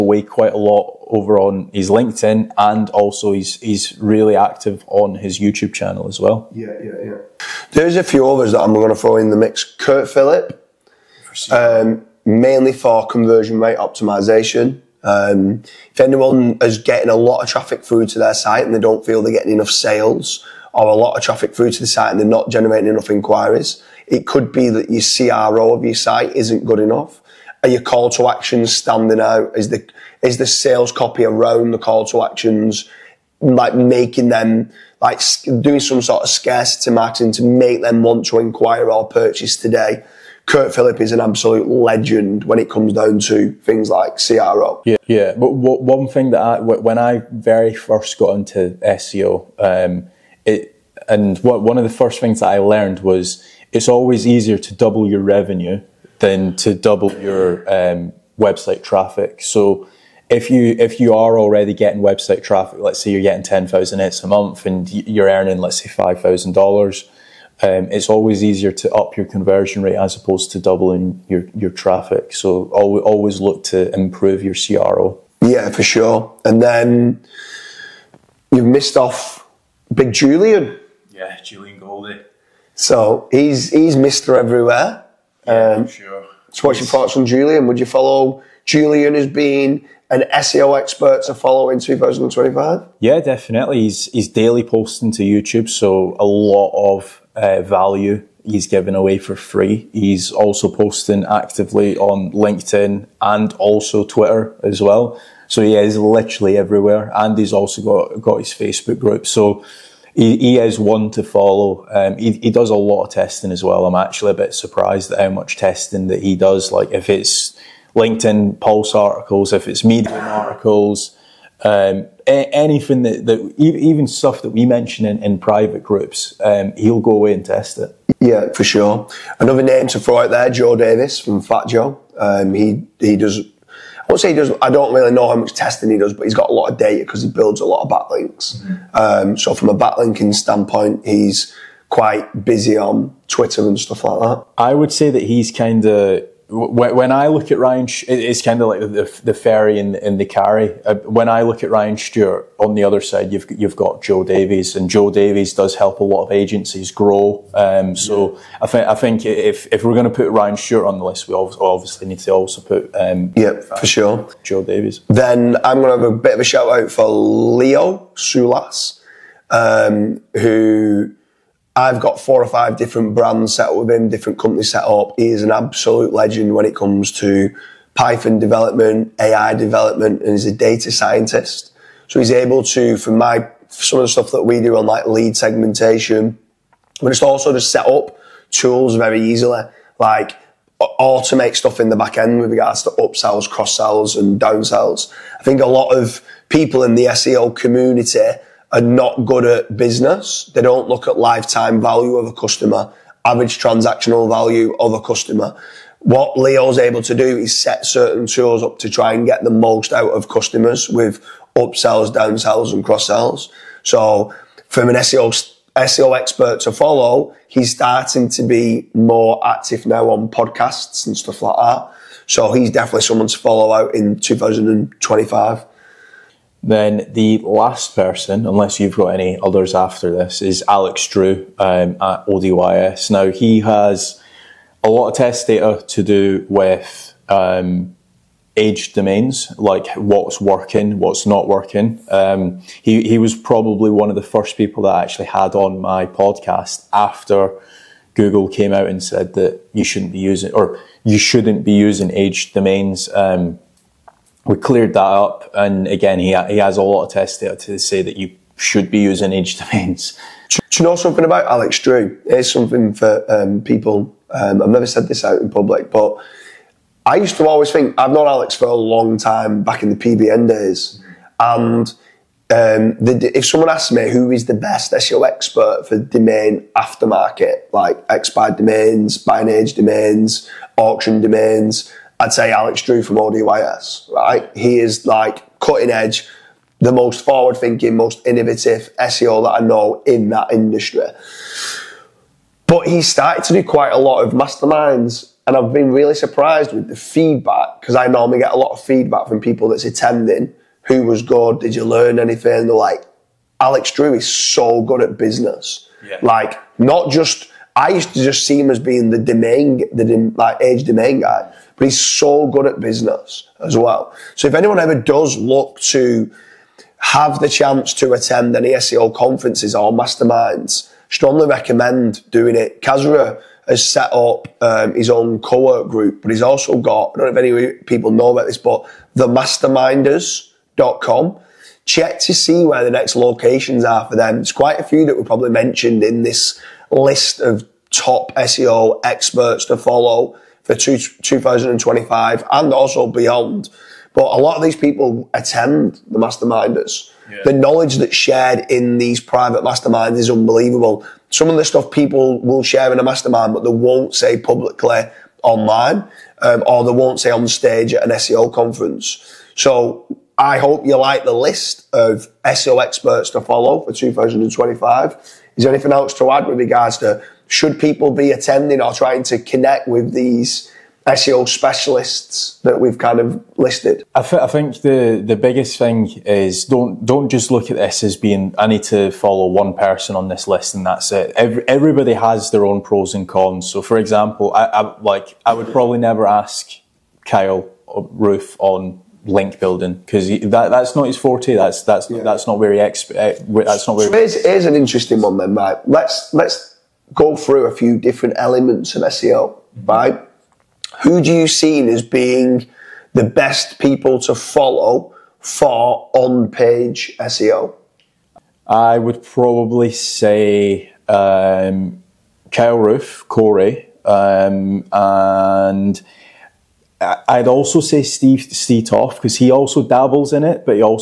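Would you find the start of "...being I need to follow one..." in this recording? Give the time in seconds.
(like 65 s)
378 s.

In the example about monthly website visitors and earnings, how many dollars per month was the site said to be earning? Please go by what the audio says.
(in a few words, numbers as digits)
5,000.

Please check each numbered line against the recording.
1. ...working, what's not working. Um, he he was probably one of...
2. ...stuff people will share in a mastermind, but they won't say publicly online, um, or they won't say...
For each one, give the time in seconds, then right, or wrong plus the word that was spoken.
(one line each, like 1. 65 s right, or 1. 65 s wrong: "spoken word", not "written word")
1. 240 s right
2. 351 s right.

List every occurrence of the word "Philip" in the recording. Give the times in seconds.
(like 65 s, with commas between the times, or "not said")
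10 s, 40 s.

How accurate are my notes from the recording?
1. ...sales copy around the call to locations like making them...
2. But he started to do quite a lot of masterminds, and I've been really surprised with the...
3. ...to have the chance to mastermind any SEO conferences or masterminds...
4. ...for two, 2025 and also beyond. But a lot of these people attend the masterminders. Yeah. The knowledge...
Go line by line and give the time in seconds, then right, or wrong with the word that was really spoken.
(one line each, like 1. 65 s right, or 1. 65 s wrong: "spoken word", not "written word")
1. 30 s wrong: "actions", not "locations"
2. 292 s right
3. 315 s wrong: "attend", not "mastermind"
4. 340 s right.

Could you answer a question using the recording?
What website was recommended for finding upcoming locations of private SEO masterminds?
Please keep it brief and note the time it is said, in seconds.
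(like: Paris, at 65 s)
themasterminders.com, at 329 s.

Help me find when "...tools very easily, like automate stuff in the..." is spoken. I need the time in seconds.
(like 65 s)
188 s.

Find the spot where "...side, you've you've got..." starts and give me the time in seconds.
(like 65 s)
153 s.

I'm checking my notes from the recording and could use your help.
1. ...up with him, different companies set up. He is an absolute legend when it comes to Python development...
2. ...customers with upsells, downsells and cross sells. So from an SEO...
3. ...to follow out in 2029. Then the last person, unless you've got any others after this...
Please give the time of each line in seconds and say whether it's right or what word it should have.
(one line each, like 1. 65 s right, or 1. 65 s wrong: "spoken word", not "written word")
1. 173 s right
2. 210 s right
3. 223 s wrong: "2025", not "2029".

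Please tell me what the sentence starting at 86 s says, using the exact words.
So what's your thoughts on Julian?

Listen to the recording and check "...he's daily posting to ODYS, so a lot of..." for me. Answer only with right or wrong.
wrong.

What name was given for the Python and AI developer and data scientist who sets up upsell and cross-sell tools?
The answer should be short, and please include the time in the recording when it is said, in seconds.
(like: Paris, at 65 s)
Leo Soulas, at 167 s.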